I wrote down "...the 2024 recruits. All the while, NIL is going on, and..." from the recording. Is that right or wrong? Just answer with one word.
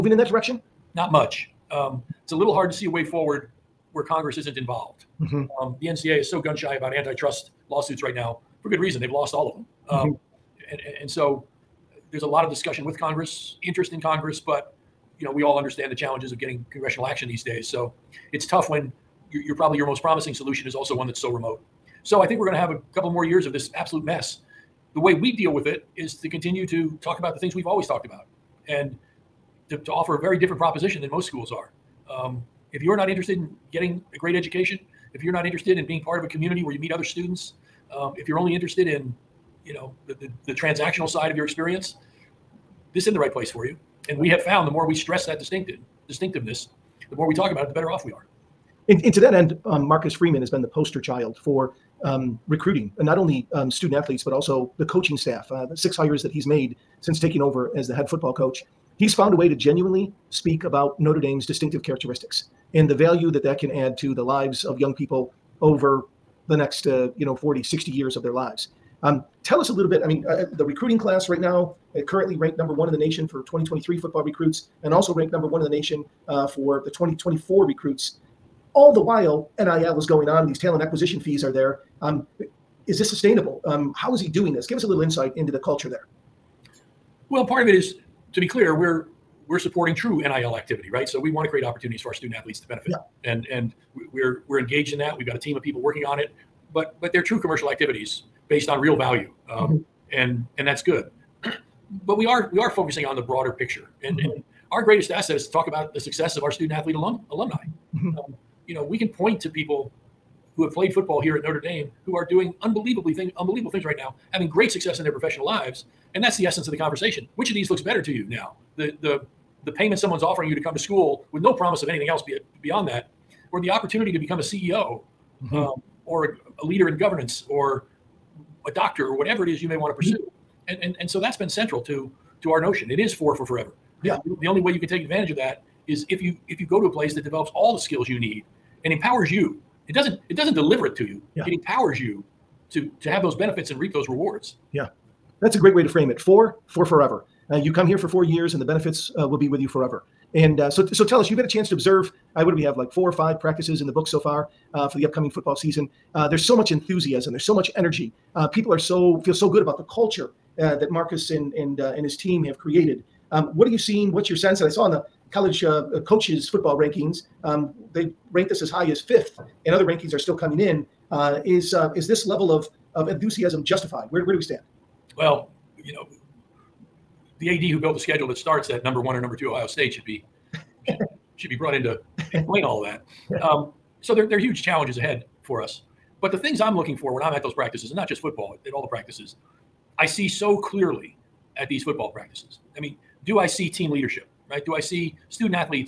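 right.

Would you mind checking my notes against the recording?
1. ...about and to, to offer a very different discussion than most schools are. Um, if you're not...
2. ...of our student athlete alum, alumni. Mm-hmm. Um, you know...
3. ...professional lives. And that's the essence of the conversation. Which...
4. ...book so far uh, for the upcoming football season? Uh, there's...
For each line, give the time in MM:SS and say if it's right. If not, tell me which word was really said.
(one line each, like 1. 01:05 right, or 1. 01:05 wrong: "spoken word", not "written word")
1. 00:28 wrong: "proposition", not "discussion"
2. 01:46 right
3. 01:55 right
4. 02:33 right.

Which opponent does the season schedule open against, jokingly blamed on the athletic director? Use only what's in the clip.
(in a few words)
Ohio State.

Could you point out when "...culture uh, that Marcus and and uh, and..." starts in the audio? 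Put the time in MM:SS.
02:39.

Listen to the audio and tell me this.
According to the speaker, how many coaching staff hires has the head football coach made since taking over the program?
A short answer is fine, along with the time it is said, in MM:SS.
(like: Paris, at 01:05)
6, at 00:55.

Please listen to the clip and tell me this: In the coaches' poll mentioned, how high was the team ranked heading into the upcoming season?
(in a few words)
Fifth.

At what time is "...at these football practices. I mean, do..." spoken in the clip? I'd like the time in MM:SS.
03:11.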